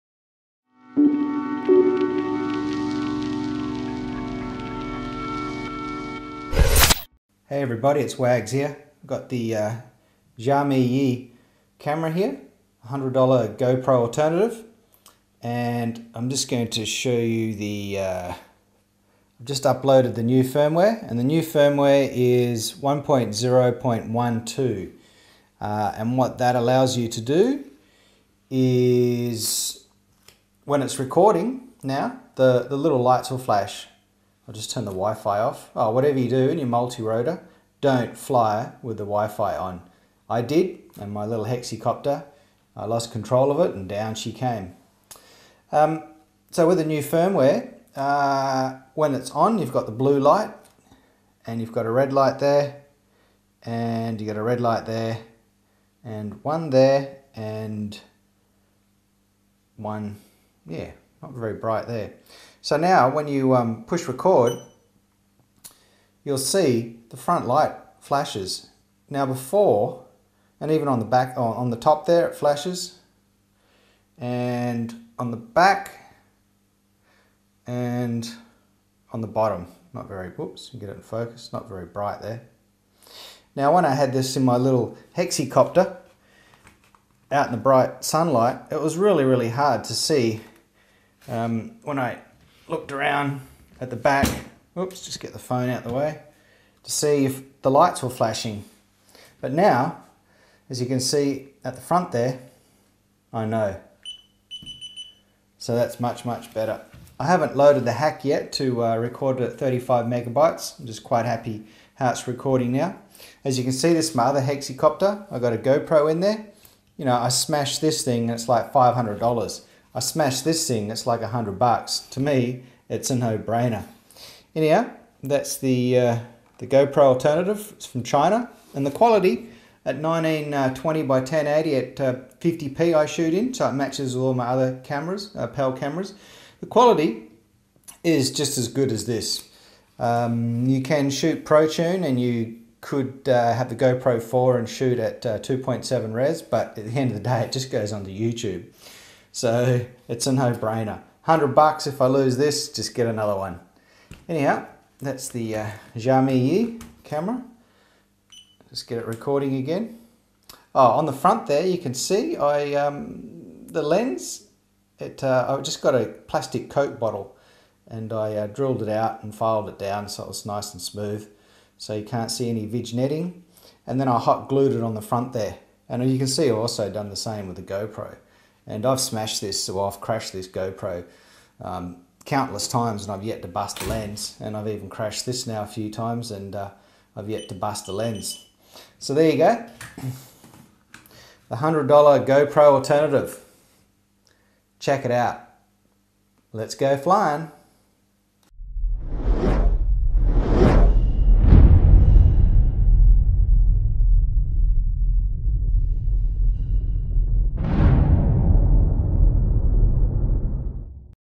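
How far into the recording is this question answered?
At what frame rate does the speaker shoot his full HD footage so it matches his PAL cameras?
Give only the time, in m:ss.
2:12.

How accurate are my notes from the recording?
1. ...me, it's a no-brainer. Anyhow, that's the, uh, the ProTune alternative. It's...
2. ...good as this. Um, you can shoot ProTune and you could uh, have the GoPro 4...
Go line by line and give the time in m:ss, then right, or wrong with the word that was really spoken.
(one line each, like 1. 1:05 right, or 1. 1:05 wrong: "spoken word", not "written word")
1. 2:02 wrong: "GoPro", not "ProTune"
2. 2:18 right.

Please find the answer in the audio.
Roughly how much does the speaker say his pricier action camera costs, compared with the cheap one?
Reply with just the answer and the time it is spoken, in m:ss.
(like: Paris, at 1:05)
$500, at 1:58.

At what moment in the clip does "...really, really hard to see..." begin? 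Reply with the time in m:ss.
1:28.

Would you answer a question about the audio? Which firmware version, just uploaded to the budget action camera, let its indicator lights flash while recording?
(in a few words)
1.0.12.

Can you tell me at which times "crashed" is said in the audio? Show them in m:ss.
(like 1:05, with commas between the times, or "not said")
2:59, 3:04.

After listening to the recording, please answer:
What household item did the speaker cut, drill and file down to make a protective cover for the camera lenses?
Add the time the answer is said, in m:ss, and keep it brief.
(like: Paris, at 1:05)
plastic Coke bottle, at 2:46.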